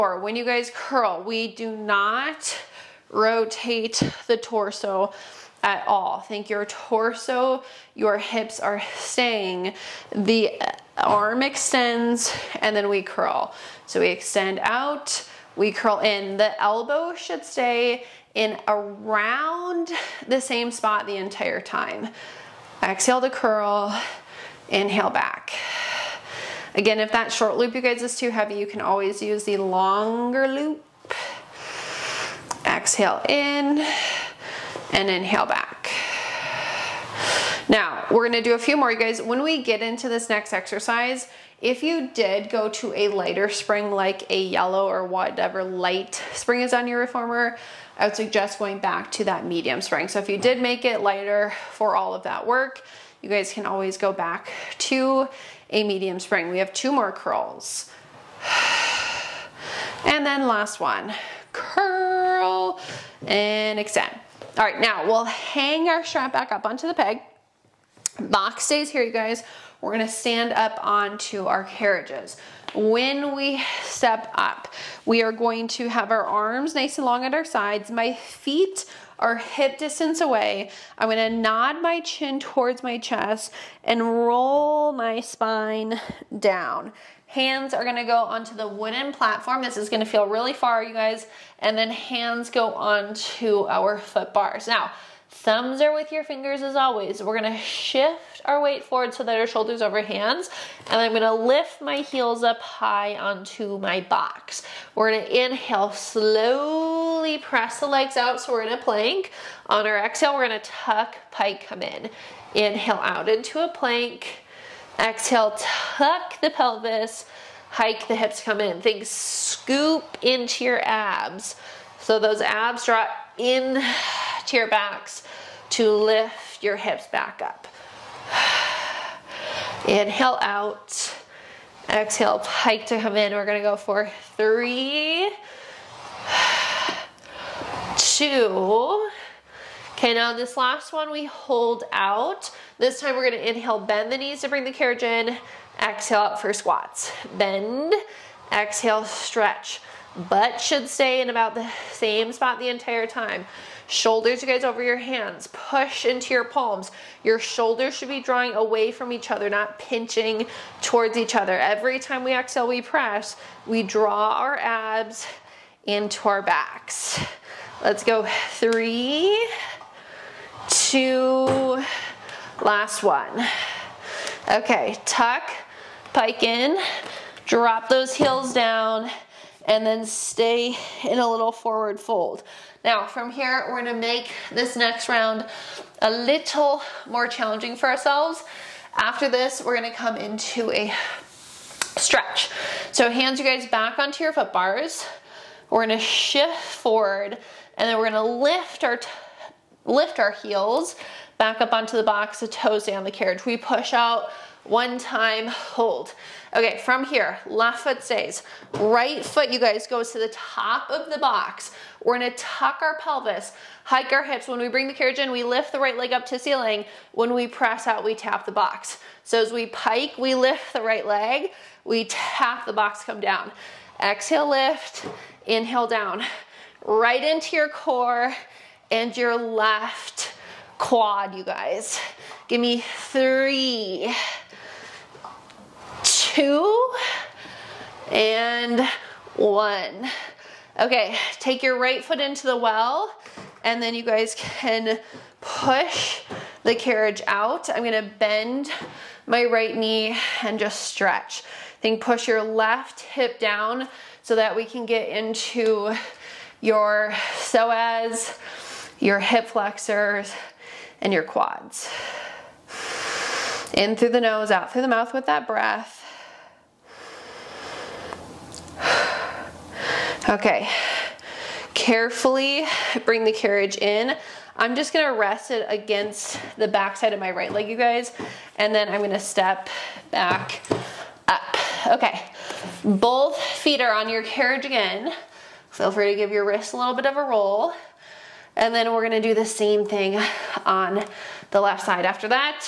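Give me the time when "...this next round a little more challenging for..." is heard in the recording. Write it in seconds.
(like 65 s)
184 s.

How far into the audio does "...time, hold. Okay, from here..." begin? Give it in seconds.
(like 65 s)
204 s.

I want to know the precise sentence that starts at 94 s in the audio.
Now, Thumbs are with your fingers as always.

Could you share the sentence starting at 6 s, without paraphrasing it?
Think your torso, your hips are staying.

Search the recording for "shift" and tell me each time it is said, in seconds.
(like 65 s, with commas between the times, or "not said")
97 s, 195 s.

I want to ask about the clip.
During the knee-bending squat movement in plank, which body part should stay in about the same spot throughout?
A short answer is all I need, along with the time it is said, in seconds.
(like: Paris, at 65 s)
Butt, at 150 s.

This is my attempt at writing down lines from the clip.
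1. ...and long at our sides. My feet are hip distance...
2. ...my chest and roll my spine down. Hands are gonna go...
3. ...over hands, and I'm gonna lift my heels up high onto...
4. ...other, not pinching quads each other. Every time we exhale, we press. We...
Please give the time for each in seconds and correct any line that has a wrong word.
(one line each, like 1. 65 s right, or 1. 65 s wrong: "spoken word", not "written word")
1. 76 s right
2. 82 s right
3. 99 s right
4. 159 s wrong: "towards", not "quads".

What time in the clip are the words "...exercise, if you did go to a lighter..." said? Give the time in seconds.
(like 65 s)
40 s.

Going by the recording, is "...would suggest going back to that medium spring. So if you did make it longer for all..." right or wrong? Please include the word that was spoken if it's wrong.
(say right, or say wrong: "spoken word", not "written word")
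wrong: "lighter", not "longer".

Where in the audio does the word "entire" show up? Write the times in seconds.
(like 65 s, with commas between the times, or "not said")
21 s, 152 s.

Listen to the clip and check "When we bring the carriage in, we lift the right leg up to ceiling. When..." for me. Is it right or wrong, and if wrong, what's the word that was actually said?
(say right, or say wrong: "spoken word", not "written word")
right.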